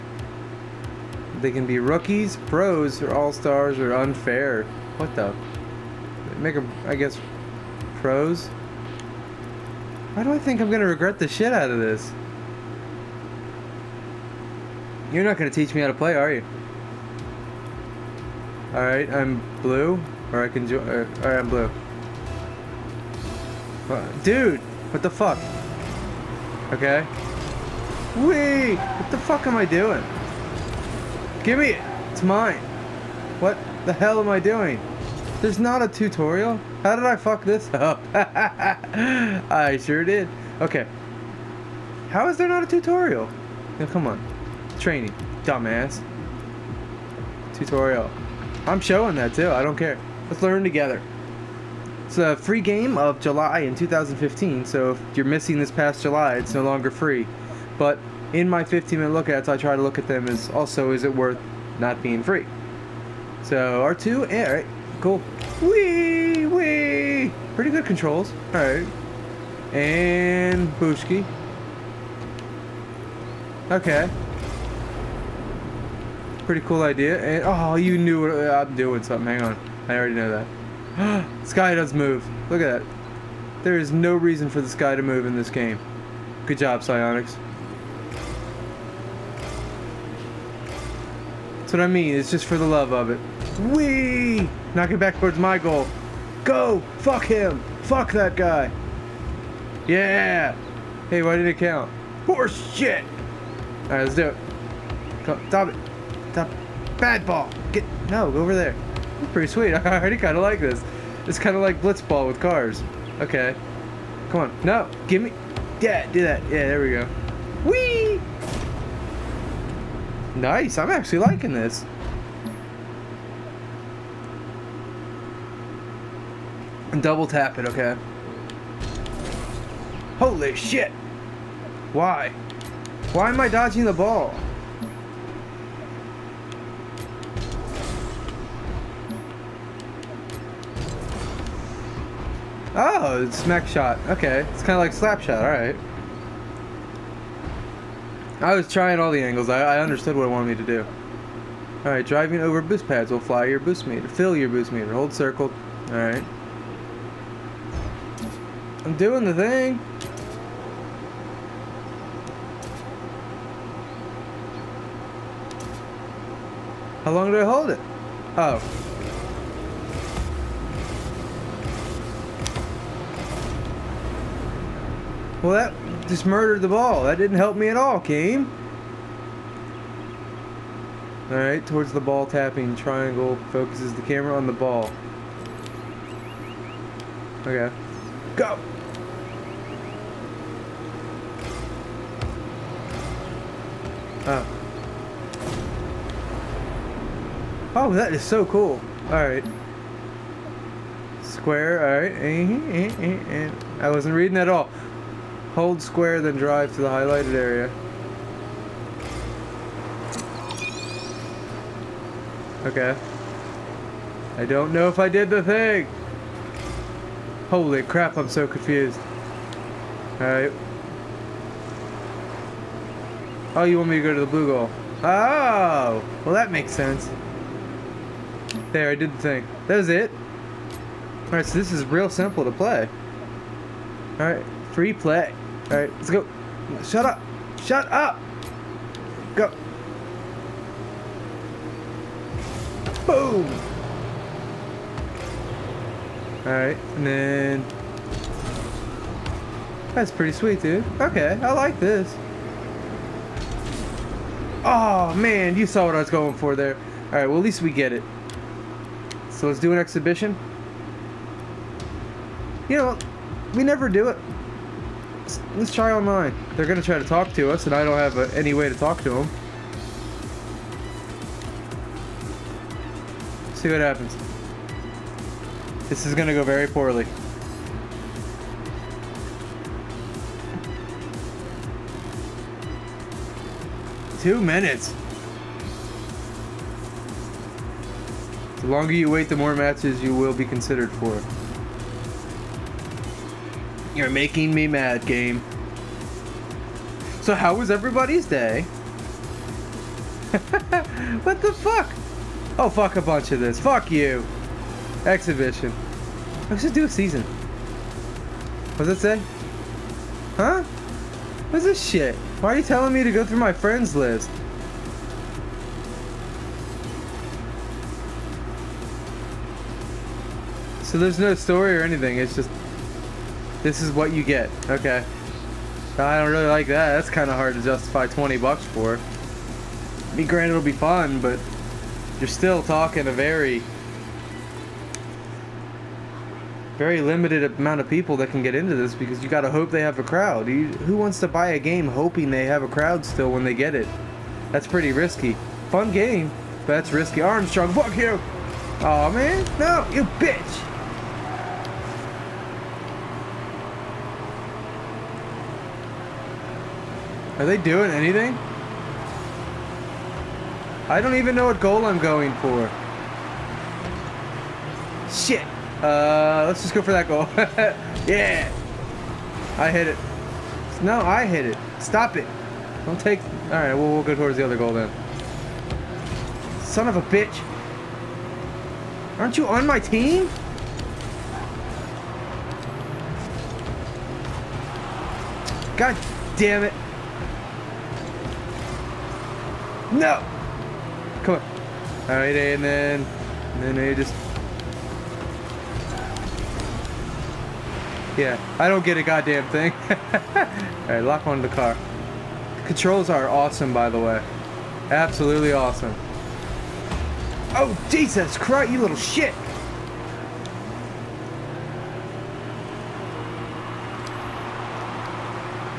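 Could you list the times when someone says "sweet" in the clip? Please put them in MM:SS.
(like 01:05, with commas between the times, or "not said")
01:49, 04:10.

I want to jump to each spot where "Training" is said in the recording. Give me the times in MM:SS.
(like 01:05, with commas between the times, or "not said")
00:44.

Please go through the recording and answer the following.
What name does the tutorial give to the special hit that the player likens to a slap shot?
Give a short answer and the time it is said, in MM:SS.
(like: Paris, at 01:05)
smack shot, at 02:23.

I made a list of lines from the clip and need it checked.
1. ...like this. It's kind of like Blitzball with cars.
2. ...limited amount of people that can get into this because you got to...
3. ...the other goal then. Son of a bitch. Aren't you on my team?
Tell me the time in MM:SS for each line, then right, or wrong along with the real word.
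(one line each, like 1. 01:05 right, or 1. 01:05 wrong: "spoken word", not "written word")
1. 01:50 right
2. 05:37 right
3. 06:14 right.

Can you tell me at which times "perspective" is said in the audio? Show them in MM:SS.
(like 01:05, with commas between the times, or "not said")
not said.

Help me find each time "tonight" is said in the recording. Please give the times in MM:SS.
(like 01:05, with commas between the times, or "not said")
not said.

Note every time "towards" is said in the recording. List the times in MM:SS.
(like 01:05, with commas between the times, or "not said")
01:34, 03:01, 06:14.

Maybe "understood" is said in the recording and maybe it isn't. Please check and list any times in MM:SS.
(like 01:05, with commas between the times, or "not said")
02:29.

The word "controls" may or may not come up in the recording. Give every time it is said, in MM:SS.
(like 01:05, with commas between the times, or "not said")
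01:07, 06:42.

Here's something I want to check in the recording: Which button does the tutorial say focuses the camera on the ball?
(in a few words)
Triangle.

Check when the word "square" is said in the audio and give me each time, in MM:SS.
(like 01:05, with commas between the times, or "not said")
03:21, 03:25.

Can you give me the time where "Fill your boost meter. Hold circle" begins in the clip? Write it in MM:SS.
02:34.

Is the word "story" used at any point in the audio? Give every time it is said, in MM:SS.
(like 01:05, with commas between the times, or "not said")
05:21.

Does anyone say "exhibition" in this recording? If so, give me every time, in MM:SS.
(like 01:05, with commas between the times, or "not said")
04:19, 05:05.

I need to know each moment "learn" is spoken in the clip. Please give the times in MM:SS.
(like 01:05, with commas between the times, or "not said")
00:50.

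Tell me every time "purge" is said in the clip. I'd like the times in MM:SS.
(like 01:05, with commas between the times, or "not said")
not said.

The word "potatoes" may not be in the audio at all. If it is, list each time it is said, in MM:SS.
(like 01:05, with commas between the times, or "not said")
not said.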